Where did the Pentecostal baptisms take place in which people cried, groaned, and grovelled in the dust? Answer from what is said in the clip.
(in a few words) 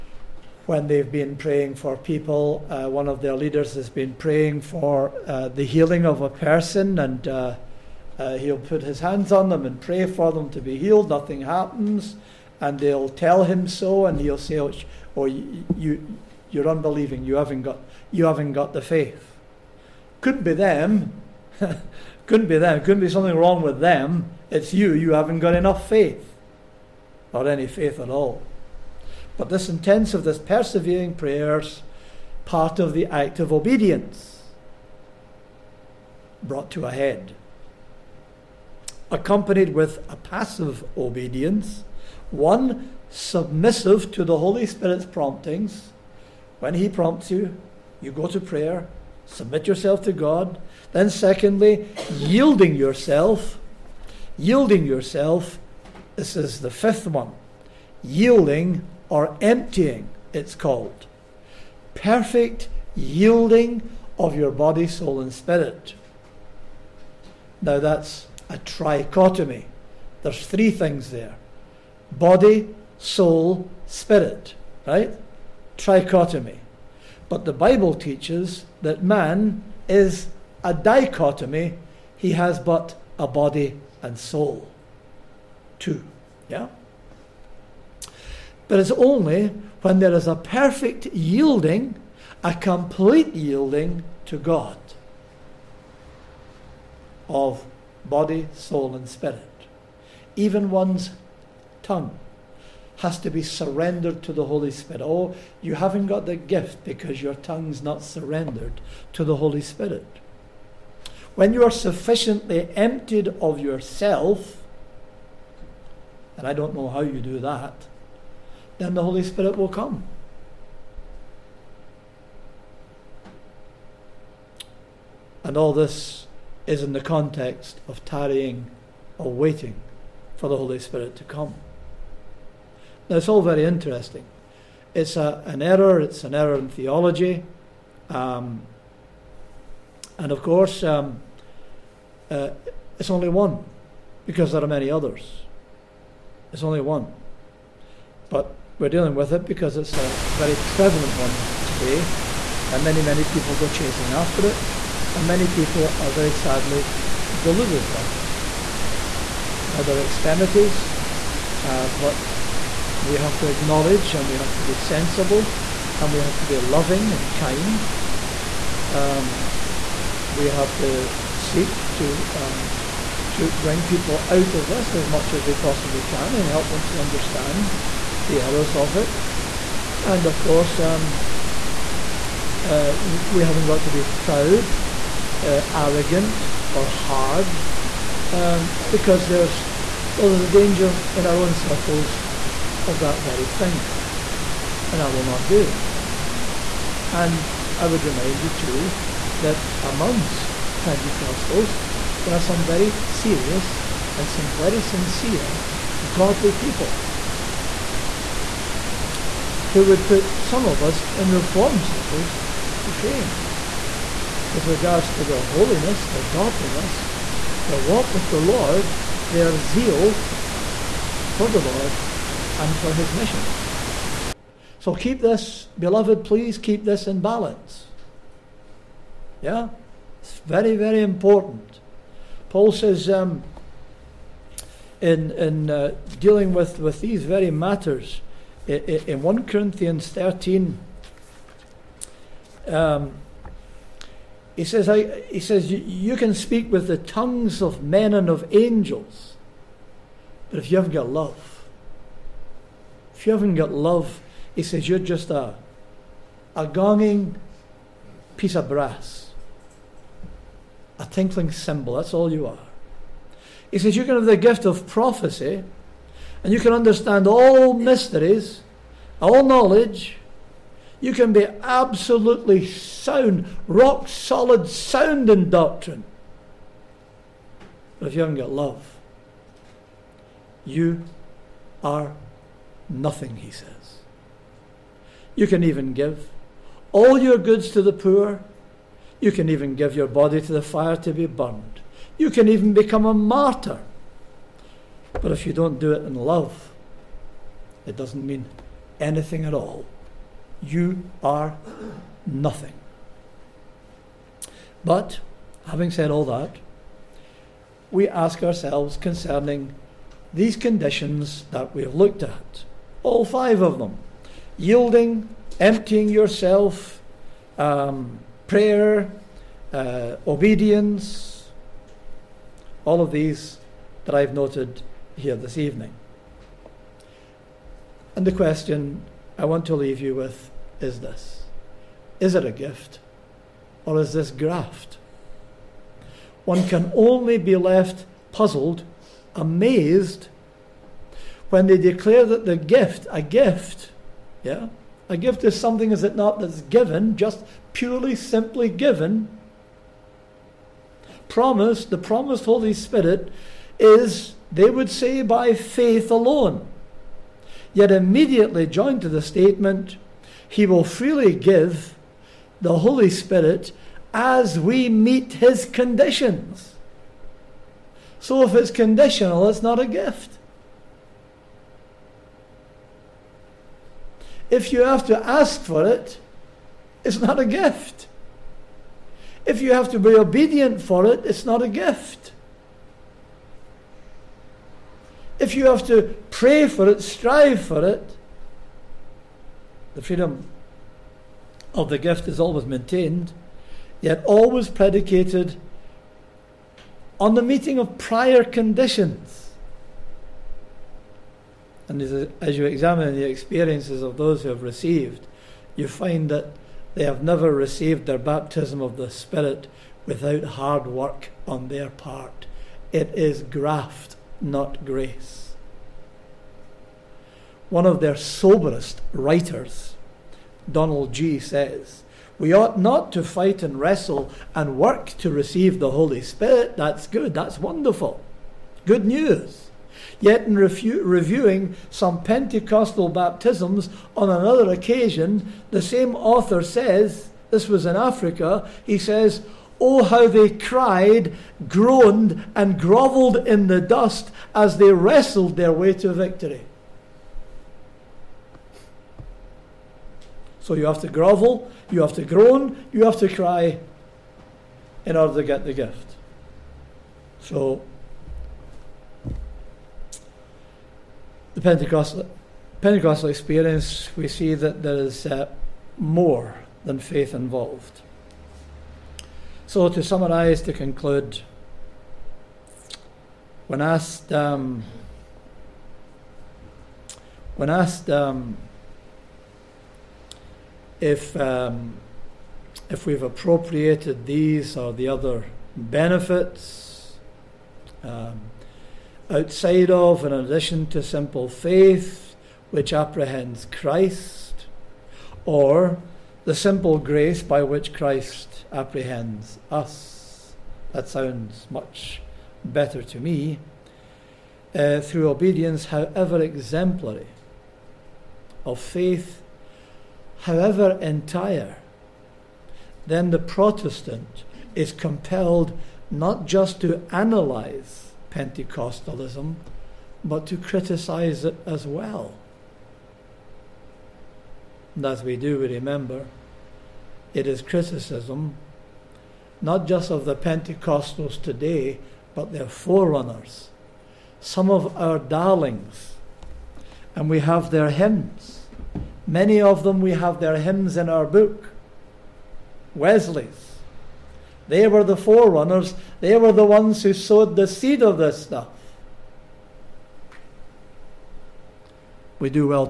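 Africa.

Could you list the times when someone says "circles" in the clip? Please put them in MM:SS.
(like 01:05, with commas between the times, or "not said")
03:11, 03:31.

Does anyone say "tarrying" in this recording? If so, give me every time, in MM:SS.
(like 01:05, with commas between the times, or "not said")
02:08.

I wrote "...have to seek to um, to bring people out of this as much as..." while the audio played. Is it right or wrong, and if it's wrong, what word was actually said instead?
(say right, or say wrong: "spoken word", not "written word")
right.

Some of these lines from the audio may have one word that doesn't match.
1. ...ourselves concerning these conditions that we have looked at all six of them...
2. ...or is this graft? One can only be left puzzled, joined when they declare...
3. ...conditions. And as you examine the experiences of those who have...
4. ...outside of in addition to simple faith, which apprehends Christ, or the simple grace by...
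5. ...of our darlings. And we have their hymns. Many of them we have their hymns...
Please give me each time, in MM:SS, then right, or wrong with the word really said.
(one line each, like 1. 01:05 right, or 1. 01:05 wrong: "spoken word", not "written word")
1. 05:08 wrong: "five", not "six"
2. 05:33 wrong: "amazed", not "joined"
3. 06:38 right
4. 08:09 right
5. 08:54 right.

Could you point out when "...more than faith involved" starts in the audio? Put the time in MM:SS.
07:45.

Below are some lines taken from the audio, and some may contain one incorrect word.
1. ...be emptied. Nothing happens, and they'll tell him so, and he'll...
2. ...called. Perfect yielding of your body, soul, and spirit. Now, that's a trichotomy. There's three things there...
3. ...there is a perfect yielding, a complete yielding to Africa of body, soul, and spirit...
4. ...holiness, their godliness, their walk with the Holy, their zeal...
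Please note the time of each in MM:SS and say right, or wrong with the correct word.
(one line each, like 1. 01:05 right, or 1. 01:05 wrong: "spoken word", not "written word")
1. 00:10 wrong: "healed", not "emptied"
2. 01:00 right
3. 01:29 wrong: "God", not "Africa"
4. 03:35 wrong: "Lord", not "Holy".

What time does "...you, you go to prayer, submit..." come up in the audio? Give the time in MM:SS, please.
00:47.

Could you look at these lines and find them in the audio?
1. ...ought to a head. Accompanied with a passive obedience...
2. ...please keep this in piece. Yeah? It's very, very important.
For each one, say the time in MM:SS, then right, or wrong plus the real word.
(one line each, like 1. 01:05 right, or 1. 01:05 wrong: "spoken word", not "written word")
1. 00:36 wrong: "brought", not "ought"
2. 03:46 wrong: "balance", not "piece".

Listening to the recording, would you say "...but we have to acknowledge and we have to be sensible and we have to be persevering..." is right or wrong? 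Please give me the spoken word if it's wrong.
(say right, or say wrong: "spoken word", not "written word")
wrong: "loving", not "persevering".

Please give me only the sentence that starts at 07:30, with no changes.
So you have to grovel, you have to groan, you have to cry in order to get the gift.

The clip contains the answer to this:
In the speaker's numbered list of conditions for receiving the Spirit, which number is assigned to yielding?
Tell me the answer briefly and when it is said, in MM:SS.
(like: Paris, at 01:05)
fifth, at 00:56.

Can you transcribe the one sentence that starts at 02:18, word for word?
Um, and of course, um, uh, it's only one because there are many others.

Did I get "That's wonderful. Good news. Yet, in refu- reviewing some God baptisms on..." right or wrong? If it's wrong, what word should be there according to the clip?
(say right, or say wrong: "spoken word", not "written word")
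wrong: "Pentecostal", not "God".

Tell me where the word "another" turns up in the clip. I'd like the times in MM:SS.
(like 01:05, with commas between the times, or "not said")
07:14.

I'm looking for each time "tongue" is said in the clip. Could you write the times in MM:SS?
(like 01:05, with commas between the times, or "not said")
01:41, 01:47, 04:06.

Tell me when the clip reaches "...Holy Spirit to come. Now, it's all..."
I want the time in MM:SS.
02:10.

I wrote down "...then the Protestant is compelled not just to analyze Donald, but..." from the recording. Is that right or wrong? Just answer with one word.
wrong.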